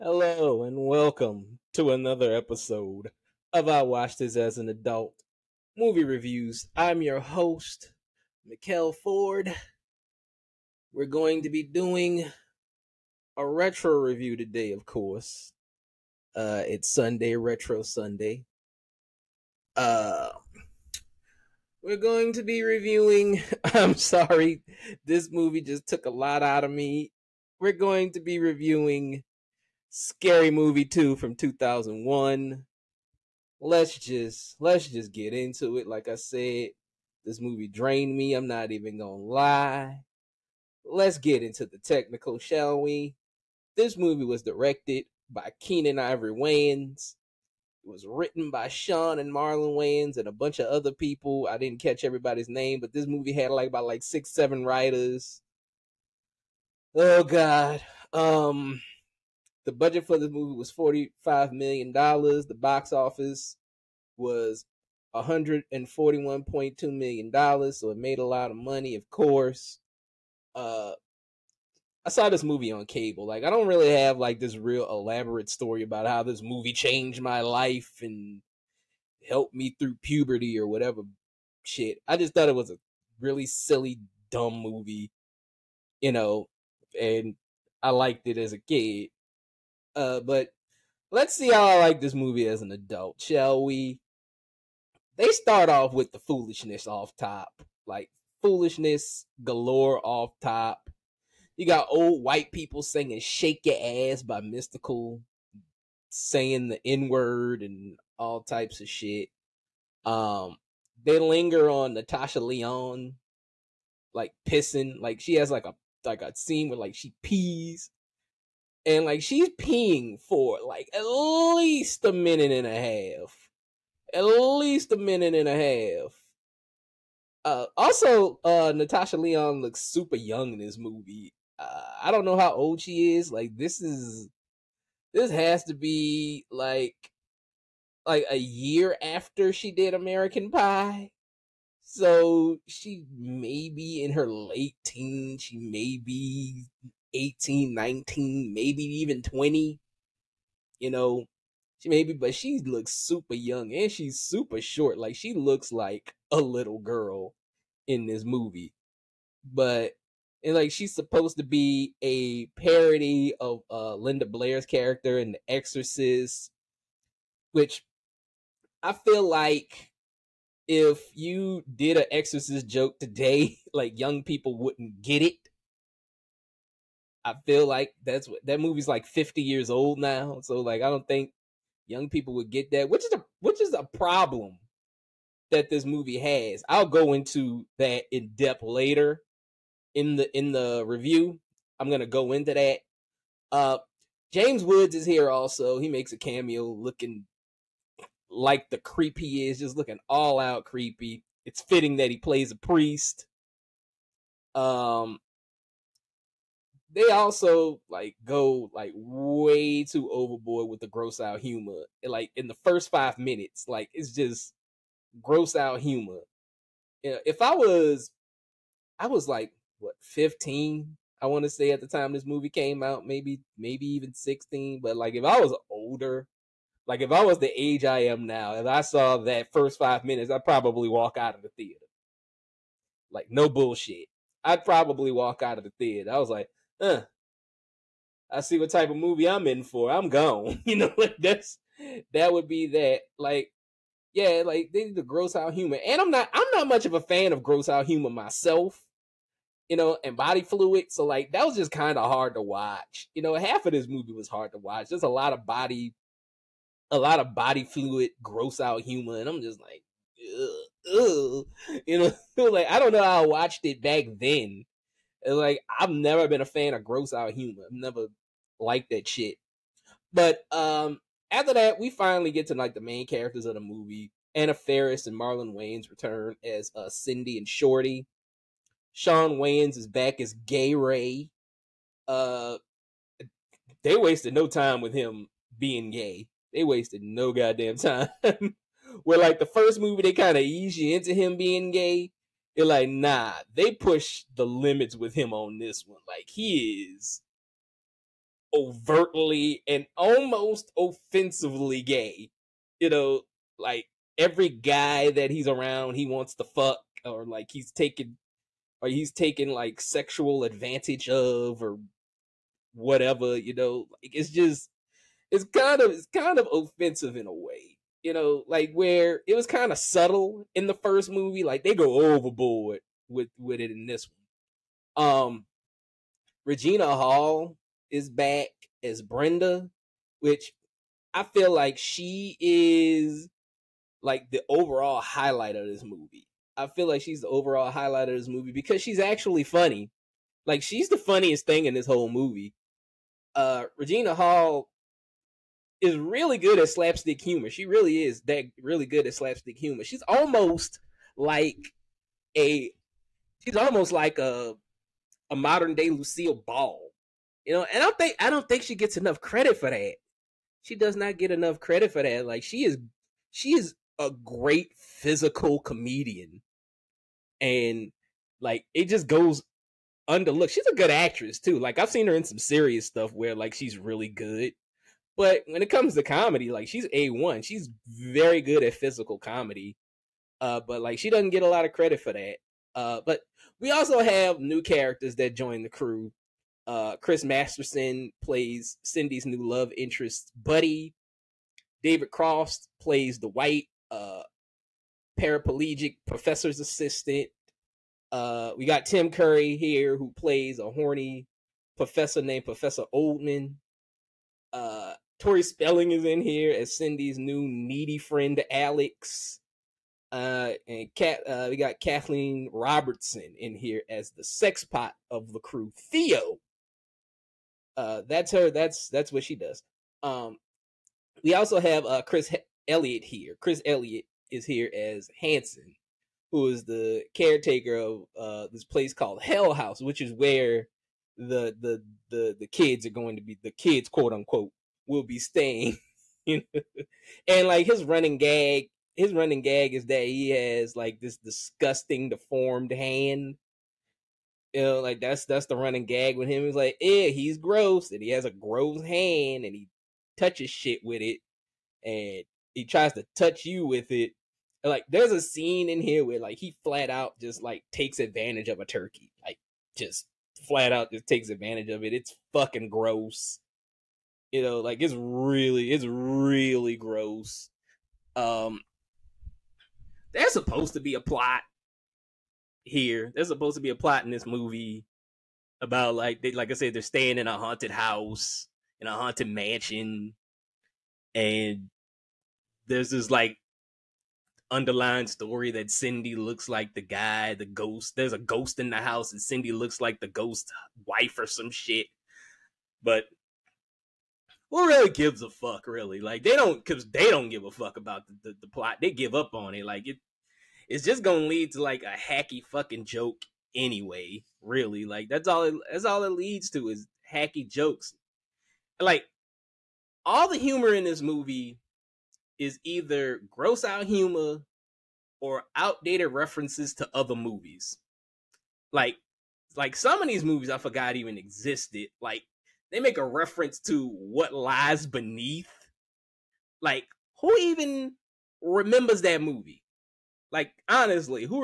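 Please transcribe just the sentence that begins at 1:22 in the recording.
I just thought it was a really silly, dumb movie, you know, and I liked it as a kid.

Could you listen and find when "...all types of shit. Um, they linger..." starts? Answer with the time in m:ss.
1:48.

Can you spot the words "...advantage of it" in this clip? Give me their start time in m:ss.
7:41.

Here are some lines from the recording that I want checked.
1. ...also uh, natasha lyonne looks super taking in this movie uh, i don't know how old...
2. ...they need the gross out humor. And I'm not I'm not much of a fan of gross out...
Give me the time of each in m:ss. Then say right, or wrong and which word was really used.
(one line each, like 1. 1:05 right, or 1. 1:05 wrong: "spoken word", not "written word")
1. 2:07 wrong: "young", not "taking"
2. 4:04 right.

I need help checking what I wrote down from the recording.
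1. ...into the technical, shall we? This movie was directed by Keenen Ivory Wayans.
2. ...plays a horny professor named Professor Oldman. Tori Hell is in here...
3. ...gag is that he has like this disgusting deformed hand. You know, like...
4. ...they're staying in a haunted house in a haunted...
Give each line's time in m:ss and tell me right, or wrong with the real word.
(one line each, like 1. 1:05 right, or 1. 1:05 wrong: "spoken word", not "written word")
1. 0:41 right
2. 6:40 wrong: "Spelling", not "Hell"
3. 7:19 right
4. 7:56 right.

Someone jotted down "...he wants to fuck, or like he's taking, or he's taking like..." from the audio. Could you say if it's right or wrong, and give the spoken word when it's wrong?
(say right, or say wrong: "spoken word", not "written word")
right.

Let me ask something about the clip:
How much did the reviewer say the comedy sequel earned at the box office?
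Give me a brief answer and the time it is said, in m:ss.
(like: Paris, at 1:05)
$141.2 million, at 1:05.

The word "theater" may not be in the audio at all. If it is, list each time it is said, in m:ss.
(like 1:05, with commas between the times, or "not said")
3:51, 3:55.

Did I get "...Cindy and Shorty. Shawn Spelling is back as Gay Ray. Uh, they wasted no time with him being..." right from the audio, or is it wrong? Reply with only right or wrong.
wrong.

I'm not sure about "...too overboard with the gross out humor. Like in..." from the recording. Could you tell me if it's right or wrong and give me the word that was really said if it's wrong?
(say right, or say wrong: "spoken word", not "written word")
right.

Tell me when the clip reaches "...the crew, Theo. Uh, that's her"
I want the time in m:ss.
6:55.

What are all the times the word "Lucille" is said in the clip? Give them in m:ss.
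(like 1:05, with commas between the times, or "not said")
5:55.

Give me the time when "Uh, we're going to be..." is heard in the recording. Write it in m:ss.
0:19.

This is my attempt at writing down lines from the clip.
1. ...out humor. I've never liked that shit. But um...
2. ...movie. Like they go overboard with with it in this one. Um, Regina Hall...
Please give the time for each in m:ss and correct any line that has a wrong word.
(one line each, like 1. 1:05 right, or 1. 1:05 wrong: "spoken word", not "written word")
1. 4:27 right
2. 5:21 right.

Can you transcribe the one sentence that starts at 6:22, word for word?
Uh, but we also have new characters that join the crew.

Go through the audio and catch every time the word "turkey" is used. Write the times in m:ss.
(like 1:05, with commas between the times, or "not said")
7:38.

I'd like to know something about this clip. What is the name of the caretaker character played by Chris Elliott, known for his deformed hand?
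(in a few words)
Hanson.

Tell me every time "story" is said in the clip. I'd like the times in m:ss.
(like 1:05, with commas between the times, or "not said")
1:15, 8:05.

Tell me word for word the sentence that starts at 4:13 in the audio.
You know, half of this movie was hard to watch.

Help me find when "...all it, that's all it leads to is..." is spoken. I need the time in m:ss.
8:25.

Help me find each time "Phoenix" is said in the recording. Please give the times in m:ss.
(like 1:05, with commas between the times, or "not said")
not said.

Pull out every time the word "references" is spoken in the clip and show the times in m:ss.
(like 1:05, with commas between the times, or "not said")
8:36, 8:43.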